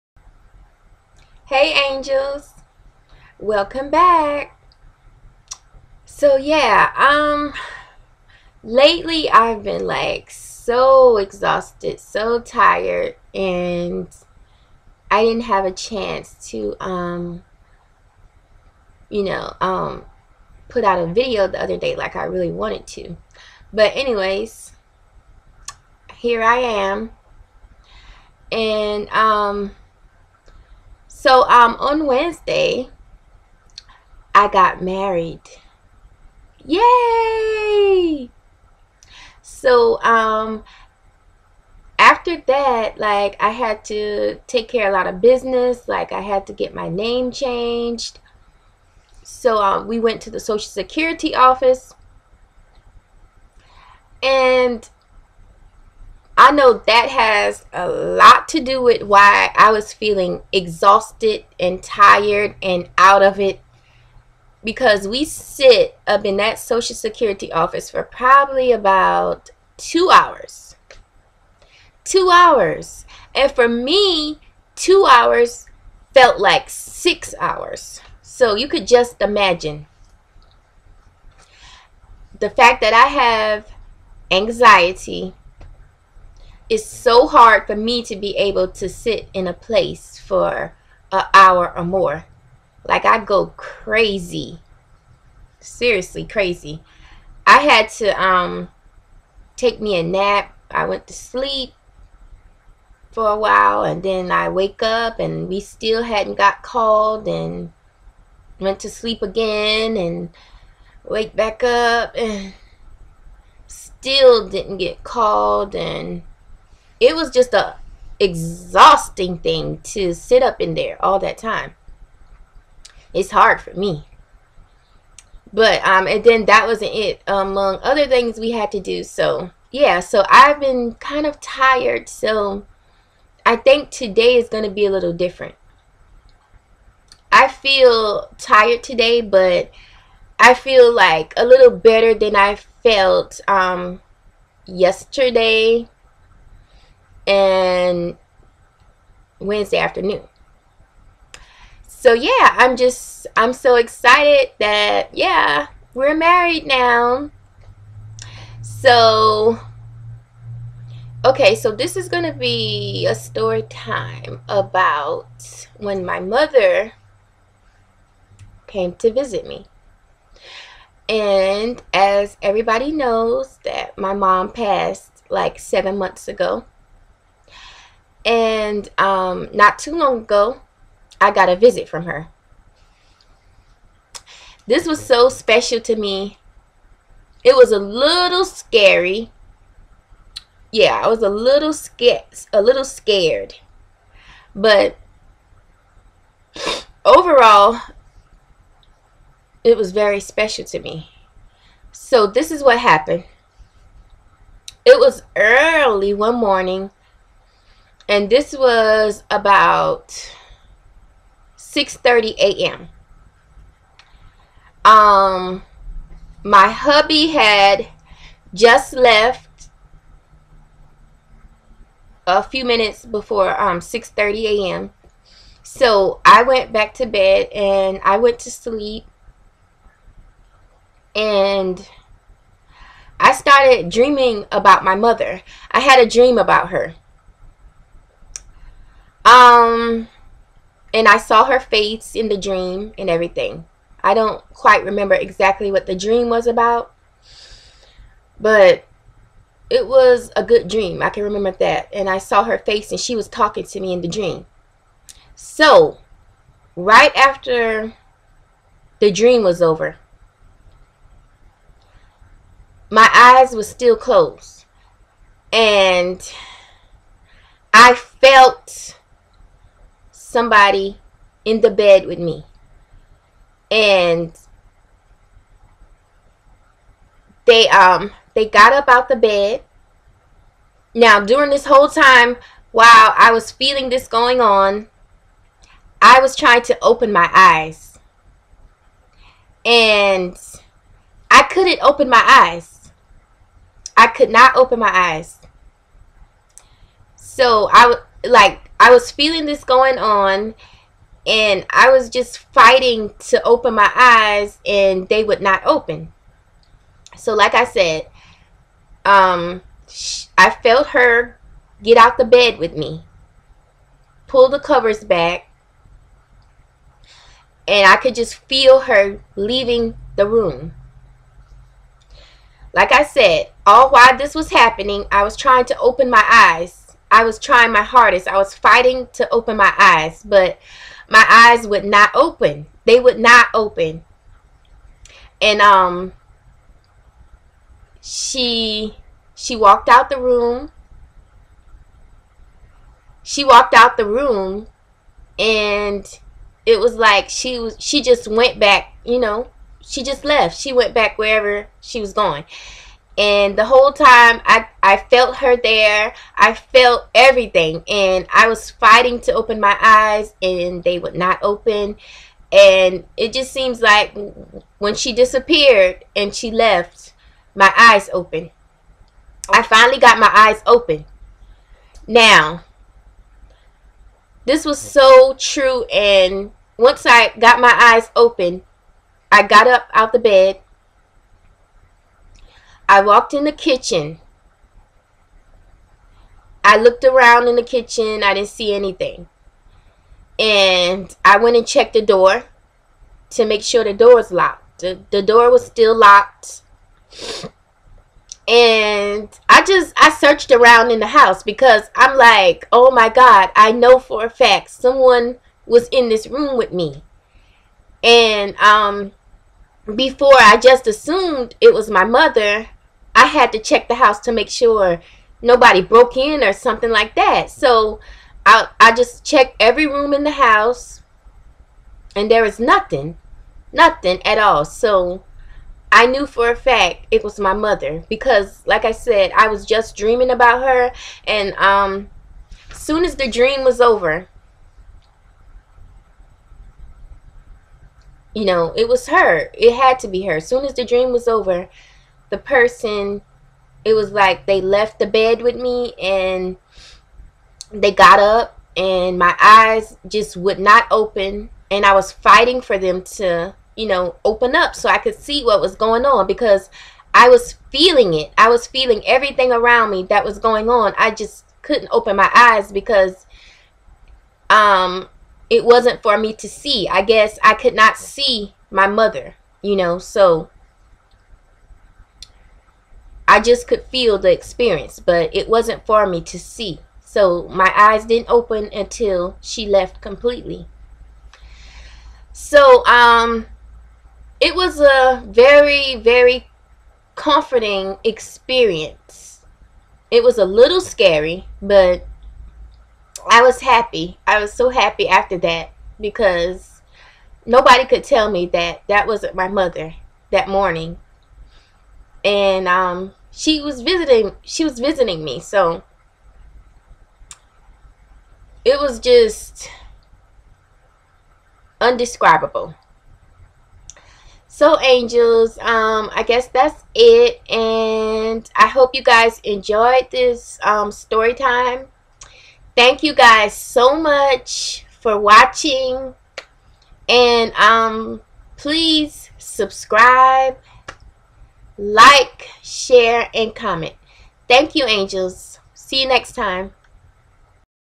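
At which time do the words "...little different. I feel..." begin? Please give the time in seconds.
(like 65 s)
134 s.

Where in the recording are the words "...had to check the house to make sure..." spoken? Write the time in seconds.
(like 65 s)
413 s.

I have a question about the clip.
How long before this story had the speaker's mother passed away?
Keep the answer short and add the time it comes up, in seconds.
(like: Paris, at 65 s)
7 months, at 175 s.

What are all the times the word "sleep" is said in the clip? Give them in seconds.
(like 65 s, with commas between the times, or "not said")
101 s, 108 s, 228 s.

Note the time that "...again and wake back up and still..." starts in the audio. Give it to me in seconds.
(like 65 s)
109 s.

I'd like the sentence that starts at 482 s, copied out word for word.
So um, it was a very, very comforting experience.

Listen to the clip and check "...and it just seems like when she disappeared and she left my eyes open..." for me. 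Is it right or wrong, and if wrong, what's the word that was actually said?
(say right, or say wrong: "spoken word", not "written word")
right.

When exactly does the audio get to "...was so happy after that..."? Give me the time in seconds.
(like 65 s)
494 s.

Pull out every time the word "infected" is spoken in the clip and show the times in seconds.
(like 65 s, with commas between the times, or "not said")
not said.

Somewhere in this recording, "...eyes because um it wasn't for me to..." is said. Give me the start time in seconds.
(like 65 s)
462 s.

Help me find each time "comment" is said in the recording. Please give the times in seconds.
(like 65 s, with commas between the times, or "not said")
533 s.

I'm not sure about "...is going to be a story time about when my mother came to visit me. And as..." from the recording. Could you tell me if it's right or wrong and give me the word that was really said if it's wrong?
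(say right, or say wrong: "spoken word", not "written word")
right.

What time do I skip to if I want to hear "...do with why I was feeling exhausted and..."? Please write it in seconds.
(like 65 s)
58 s.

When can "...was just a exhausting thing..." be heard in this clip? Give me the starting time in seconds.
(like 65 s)
117 s.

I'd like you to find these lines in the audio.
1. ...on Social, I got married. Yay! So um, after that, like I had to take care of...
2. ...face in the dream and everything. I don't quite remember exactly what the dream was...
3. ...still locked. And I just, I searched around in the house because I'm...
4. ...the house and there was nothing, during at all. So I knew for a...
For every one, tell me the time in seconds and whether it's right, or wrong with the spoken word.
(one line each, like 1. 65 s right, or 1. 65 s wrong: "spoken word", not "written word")
1. 31 s wrong: "Wednesday", not "Social"
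2. 241 s right
3. 395 s right
4. 420 s wrong: "nothing", not "during".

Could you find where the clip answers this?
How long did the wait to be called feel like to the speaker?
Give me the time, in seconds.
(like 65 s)
76 s.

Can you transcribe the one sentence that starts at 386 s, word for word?
I looked around in the kitchen.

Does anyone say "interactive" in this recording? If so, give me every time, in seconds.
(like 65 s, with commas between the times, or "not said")
not said.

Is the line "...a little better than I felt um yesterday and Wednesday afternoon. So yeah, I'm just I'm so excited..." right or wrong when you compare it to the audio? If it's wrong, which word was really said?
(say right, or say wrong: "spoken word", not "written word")
right.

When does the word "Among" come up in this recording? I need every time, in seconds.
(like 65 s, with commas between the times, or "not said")
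127 s.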